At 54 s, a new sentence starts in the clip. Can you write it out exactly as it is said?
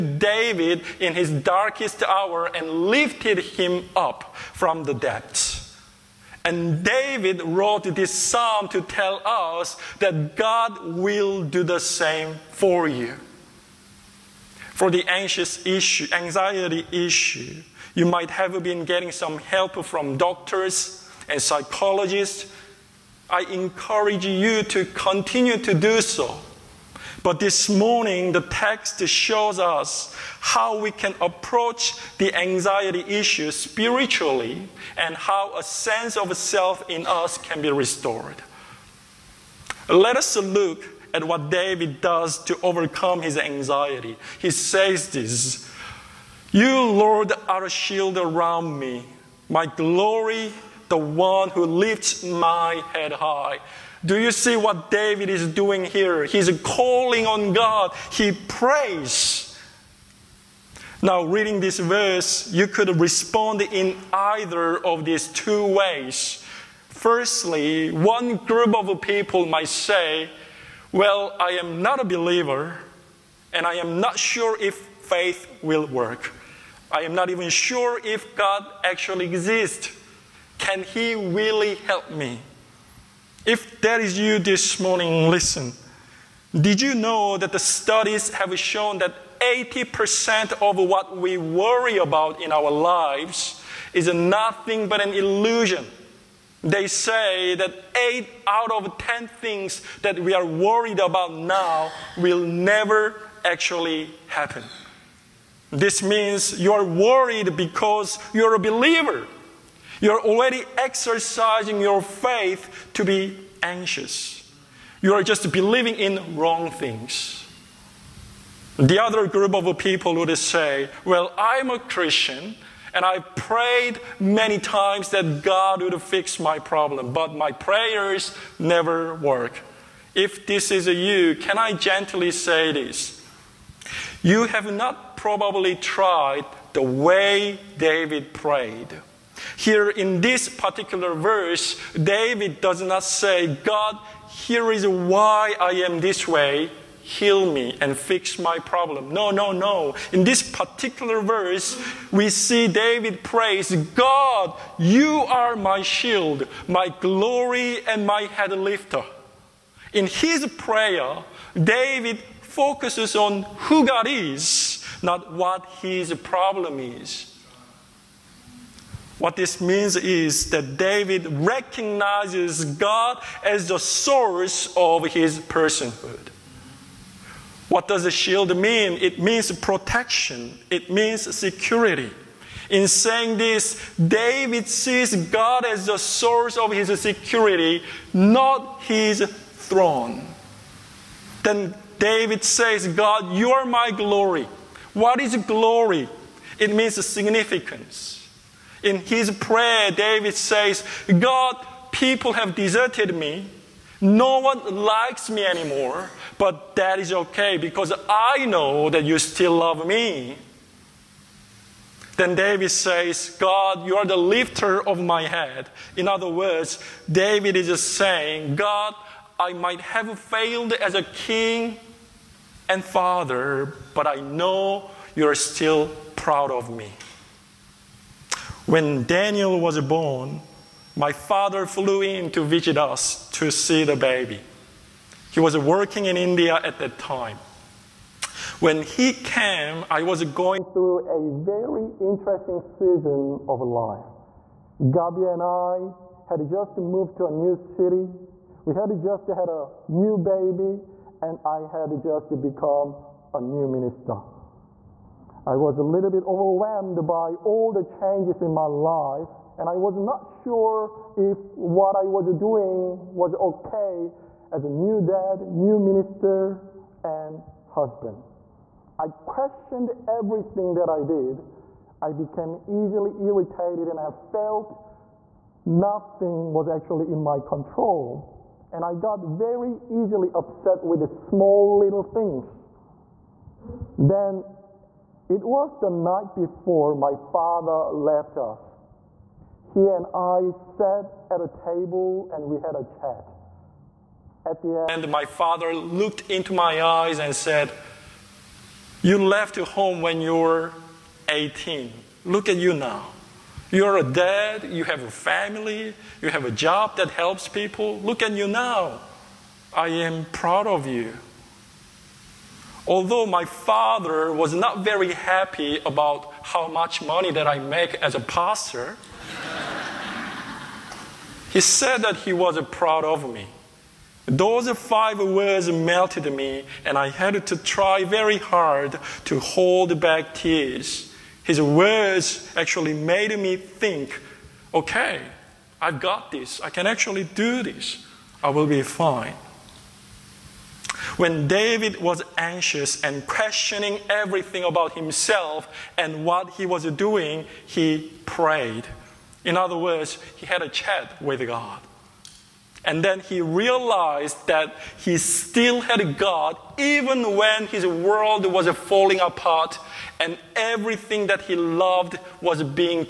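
Do you see what David is doing here?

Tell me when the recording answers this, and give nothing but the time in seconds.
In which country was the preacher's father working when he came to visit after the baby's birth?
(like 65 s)
236 s.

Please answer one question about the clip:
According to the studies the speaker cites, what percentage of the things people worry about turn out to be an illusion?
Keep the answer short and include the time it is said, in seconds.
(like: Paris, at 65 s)
80%, at 89 s.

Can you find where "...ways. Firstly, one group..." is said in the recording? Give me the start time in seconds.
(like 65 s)
65 s.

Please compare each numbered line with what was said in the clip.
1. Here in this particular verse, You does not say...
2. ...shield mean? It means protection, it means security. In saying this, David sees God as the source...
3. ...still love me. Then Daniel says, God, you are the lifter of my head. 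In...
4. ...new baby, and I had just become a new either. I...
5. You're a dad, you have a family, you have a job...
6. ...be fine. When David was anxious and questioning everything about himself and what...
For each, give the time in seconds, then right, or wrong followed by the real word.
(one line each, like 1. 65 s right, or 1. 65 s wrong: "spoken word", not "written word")
1. 139 s wrong: "David", not "You"
2. 178 s right
3. 209 s wrong: "David", not "Daniel"
4. 249 s wrong: "minister", not "either"
5. 303 s right
6. 338 s right.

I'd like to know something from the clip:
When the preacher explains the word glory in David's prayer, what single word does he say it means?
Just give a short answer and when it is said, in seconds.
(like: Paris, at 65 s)
Significance, at 197 s.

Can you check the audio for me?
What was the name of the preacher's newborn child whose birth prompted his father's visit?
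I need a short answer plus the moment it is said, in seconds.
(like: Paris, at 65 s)
Daniel, at 229 s.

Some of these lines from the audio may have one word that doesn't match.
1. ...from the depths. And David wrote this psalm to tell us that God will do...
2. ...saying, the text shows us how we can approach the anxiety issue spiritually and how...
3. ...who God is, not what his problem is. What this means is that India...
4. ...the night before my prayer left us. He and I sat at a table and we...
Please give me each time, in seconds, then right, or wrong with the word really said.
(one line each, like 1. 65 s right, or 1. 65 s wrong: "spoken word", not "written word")
1. 4 s right
2. 27 s wrong: "morning", not "saying"
3. 163 s wrong: "David", not "India"
4. 285 s wrong: "father", not "prayer".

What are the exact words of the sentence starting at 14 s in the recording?
For the anxious issue, anxiety issue, you might have been getting some help from doctors and psychologists.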